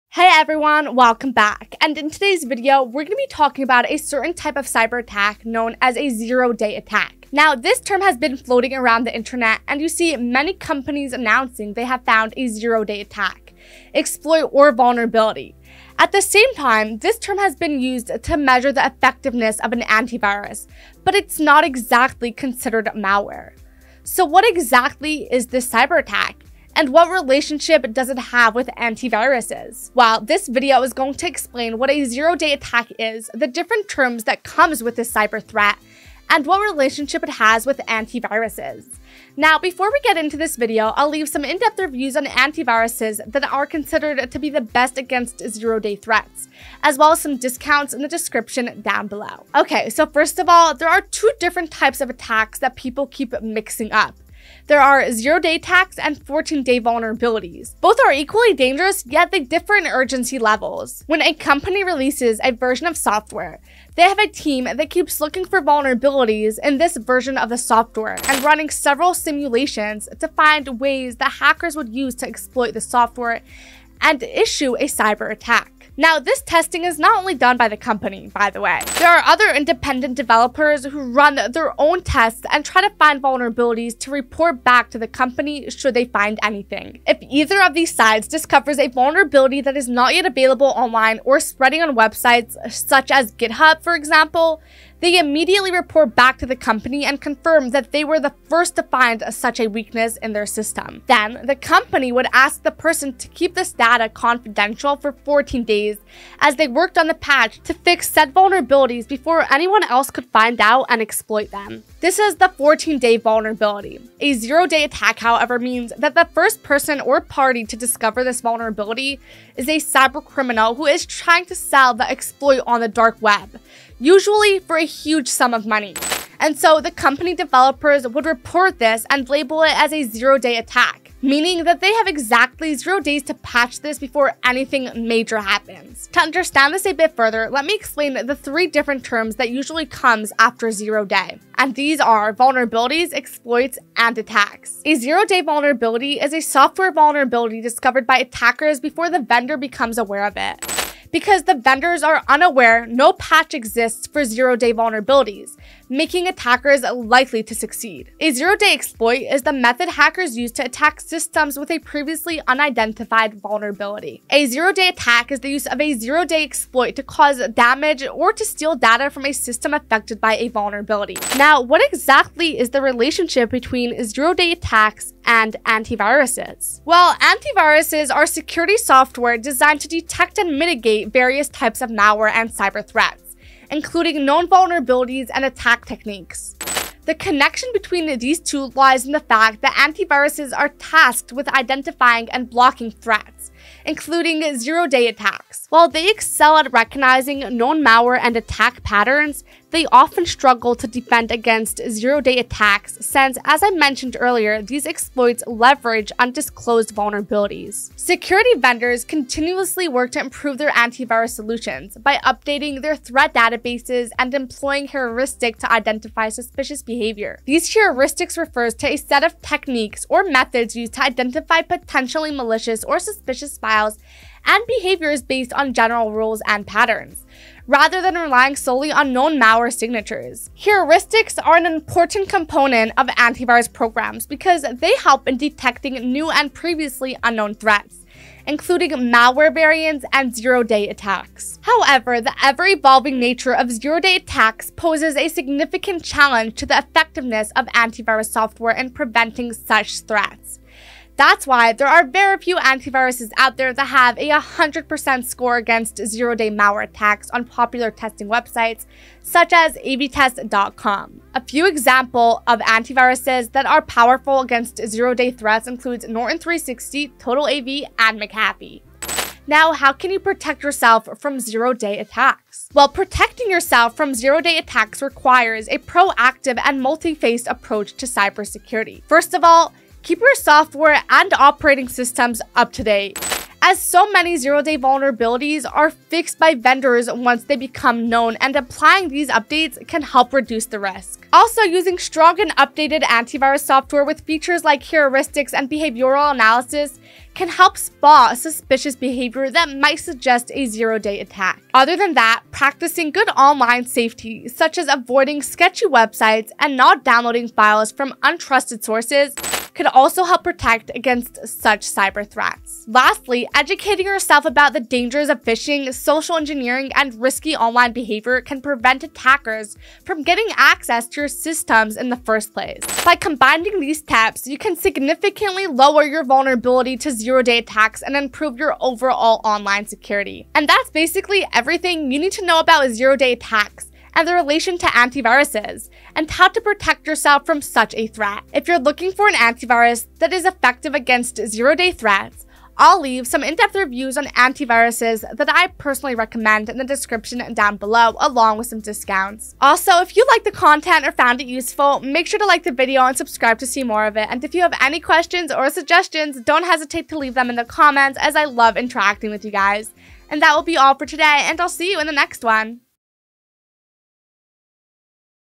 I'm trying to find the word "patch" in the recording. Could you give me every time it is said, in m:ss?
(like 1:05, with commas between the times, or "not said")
1:47, 2:13, 2:33.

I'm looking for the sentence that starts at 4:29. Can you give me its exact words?
Now, how can you protect yourself from zero day attacks?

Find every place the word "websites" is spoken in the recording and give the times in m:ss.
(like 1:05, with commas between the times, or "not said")
1:31, 4:18, 5:05.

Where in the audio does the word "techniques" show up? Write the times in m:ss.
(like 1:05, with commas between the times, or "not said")
3:05, 3:39.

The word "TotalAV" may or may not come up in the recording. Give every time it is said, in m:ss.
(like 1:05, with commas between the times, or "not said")
4:27.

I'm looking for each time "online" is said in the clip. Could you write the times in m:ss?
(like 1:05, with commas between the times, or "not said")
1:30, 5:03, 5:17, 5:29.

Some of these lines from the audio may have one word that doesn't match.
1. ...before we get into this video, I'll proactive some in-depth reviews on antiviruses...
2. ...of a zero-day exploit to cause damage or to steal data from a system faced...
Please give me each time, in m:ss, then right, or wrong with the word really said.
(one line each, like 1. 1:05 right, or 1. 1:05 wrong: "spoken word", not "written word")
1. 0:39 wrong: "leave", not "proactive"
2. 2:45 wrong: "affected", not "faced".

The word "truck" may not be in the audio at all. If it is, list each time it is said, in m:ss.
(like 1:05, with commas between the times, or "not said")
not said.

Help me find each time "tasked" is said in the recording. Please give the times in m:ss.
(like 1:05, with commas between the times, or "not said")
3:10.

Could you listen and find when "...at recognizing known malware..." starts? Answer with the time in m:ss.
3:16.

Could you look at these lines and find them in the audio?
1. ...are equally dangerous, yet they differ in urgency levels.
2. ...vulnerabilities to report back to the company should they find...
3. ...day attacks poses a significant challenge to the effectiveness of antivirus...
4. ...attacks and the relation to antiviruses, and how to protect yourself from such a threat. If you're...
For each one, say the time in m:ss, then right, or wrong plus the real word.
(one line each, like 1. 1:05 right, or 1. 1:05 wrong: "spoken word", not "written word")
1. 0:58 right
2. 1:23 right
3. 4:03 right
4. 5:33 right.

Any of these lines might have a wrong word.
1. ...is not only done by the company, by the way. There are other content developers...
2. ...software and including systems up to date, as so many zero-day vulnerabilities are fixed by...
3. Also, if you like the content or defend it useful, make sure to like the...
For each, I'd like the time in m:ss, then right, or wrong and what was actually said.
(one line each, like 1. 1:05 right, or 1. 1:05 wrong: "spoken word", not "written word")
1. 1:16 wrong: "independent", not "content"
2. 4:40 wrong: "operating", not "including"
3. 5:49 wrong: "found", not "defend".